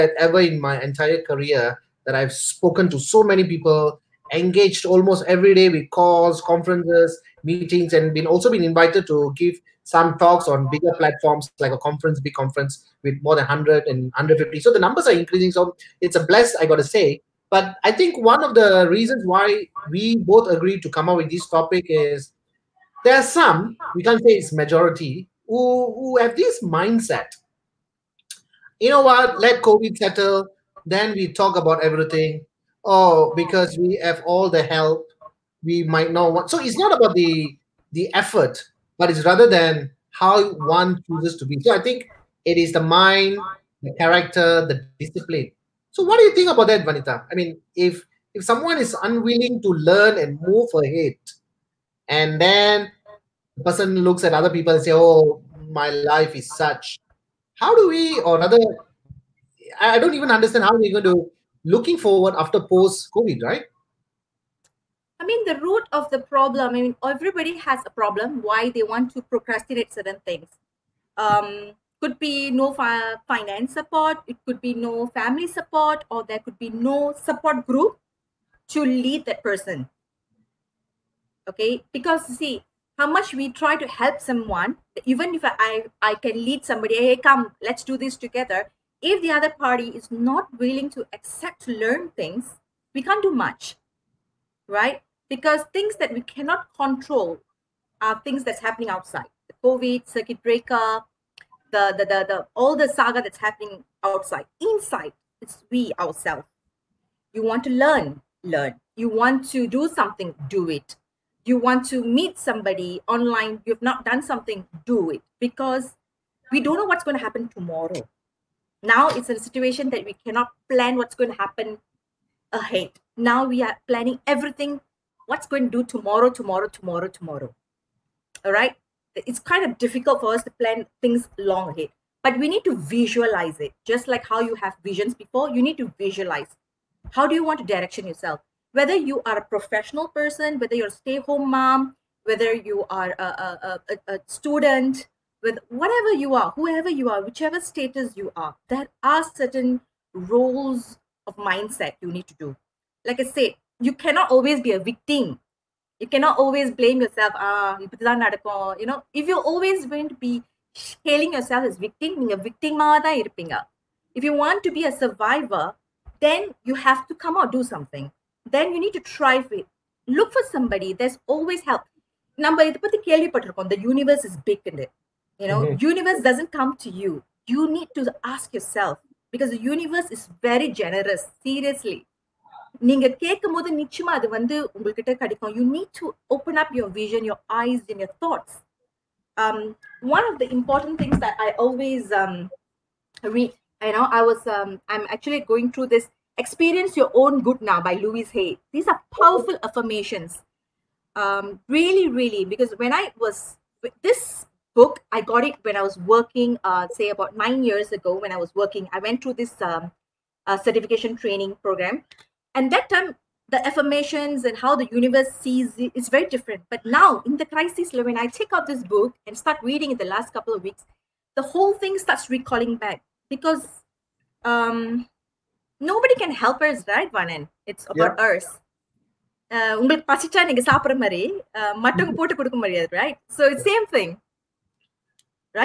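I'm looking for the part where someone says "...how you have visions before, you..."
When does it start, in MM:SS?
02:14.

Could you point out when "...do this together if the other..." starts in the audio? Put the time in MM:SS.
01:27.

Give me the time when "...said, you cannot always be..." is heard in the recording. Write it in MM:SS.
02:33.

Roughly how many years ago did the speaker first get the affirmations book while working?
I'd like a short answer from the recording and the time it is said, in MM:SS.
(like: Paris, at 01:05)
9, at 03:27.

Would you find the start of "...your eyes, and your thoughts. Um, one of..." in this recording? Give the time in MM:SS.
03:07.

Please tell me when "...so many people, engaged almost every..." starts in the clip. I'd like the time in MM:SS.
00:02.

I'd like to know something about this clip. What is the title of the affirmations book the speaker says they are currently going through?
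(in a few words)
Experience Your Own Good Now.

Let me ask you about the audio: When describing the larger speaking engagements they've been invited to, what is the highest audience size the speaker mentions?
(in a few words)
150.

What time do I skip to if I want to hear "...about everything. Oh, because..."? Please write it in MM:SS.
00:31.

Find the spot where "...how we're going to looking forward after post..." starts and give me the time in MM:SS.
01:00.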